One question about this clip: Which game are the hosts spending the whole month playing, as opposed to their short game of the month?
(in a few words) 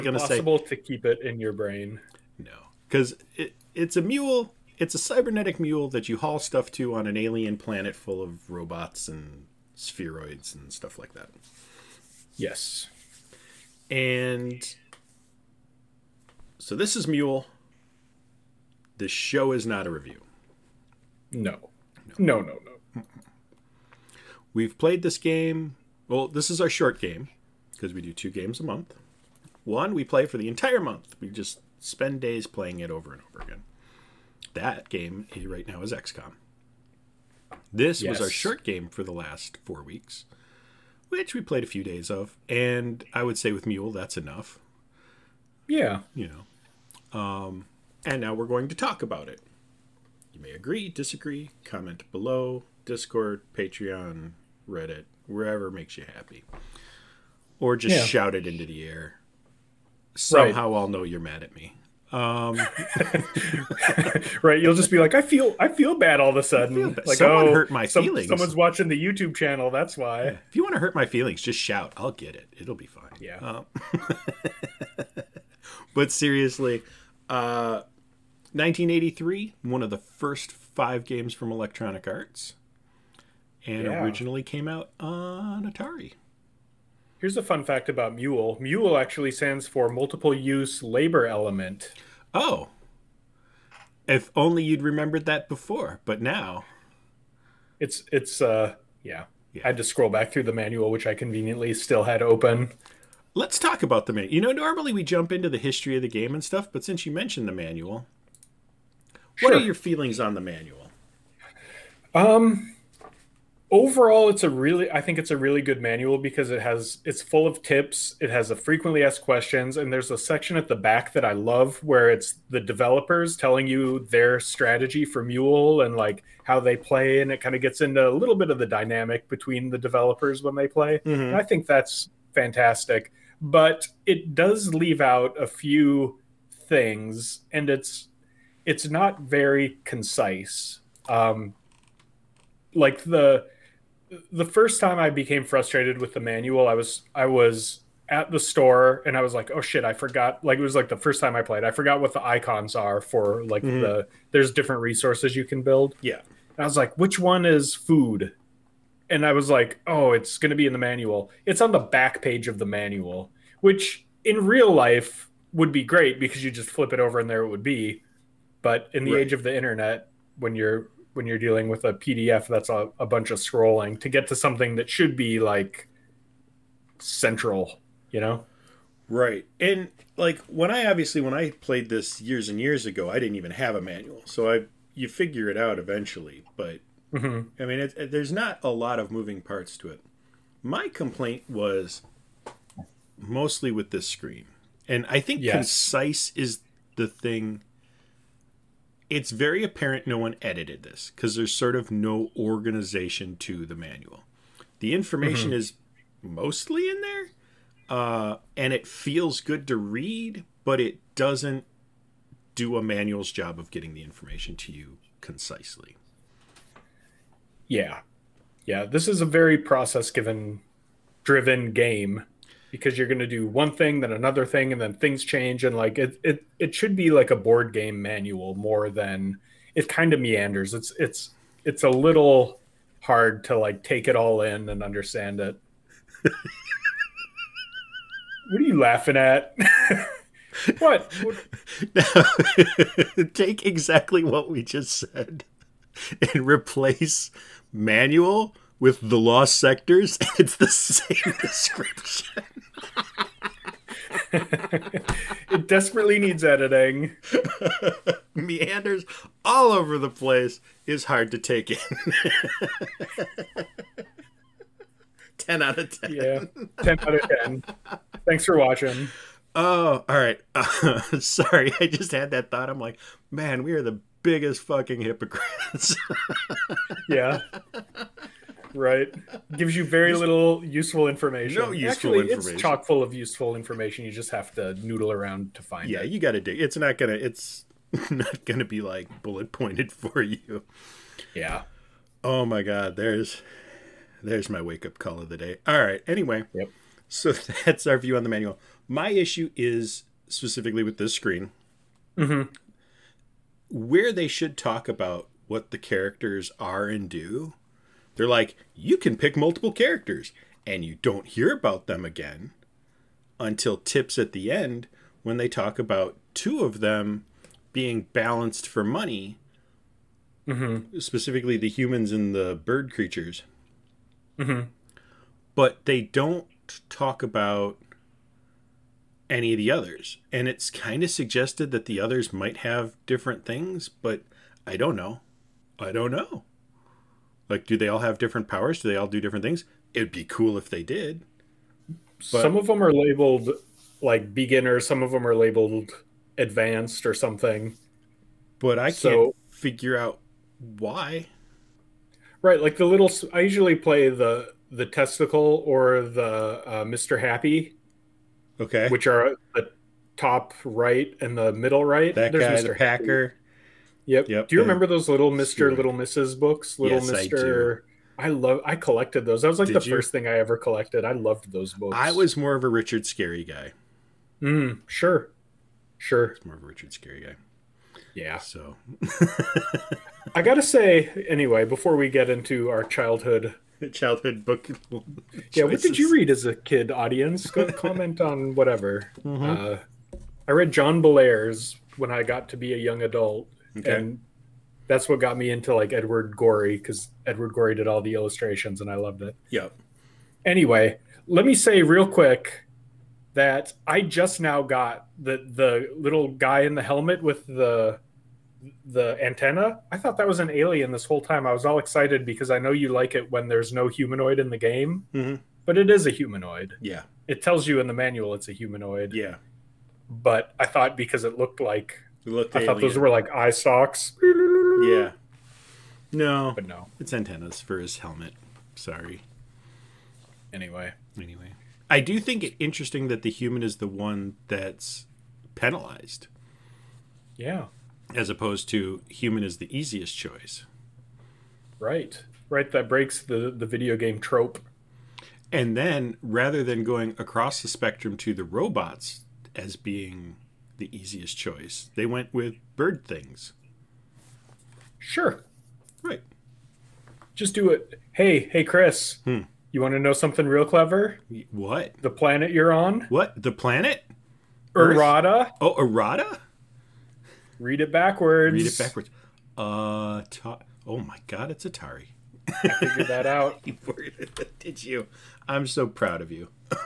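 XCOM.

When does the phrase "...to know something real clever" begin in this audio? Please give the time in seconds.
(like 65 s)
459 s.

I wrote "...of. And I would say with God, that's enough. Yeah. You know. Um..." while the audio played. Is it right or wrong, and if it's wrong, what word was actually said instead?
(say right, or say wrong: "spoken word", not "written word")
wrong: "Mule", not "God".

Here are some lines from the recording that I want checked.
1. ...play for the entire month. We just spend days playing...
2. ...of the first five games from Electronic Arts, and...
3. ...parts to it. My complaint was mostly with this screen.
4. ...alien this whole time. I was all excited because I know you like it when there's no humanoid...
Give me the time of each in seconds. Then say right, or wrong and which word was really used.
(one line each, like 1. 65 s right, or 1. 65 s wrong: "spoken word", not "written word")
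1. 30 s right
2. 79 s right
3. 189 s right
4. 410 s right.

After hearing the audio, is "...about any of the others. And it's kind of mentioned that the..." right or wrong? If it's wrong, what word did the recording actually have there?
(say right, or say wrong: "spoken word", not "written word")
wrong: "suggested", not "mentioned".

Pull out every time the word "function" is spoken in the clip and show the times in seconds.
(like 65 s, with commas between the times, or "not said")
not said.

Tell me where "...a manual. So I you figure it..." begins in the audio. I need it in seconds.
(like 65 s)
183 s.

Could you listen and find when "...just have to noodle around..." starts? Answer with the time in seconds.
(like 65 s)
284 s.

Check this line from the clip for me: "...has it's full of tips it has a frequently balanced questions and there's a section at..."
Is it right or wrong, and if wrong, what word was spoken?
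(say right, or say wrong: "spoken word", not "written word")
wrong: "asked", not "balanced".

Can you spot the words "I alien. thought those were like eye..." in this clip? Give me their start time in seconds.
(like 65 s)
422 s.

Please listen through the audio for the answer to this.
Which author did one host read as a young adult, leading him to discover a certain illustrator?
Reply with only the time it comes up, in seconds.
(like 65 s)
390 s.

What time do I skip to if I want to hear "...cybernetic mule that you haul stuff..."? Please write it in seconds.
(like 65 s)
4 s.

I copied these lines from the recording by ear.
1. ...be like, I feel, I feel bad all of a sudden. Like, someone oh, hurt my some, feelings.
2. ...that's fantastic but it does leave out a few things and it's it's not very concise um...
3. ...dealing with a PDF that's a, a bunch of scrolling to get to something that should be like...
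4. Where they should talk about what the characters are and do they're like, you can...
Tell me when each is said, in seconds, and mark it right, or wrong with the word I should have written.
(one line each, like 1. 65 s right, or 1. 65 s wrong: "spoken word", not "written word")
1. 64 s right
2. 131 s right
3. 171 s right
4. 303 s right.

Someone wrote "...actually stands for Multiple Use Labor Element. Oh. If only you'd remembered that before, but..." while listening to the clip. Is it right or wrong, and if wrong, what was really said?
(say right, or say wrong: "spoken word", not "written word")
right.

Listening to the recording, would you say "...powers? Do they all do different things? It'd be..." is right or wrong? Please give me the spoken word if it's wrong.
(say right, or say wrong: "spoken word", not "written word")
right.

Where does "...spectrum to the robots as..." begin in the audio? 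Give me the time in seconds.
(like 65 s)
447 s.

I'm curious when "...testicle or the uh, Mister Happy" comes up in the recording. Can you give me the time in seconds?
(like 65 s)
354 s.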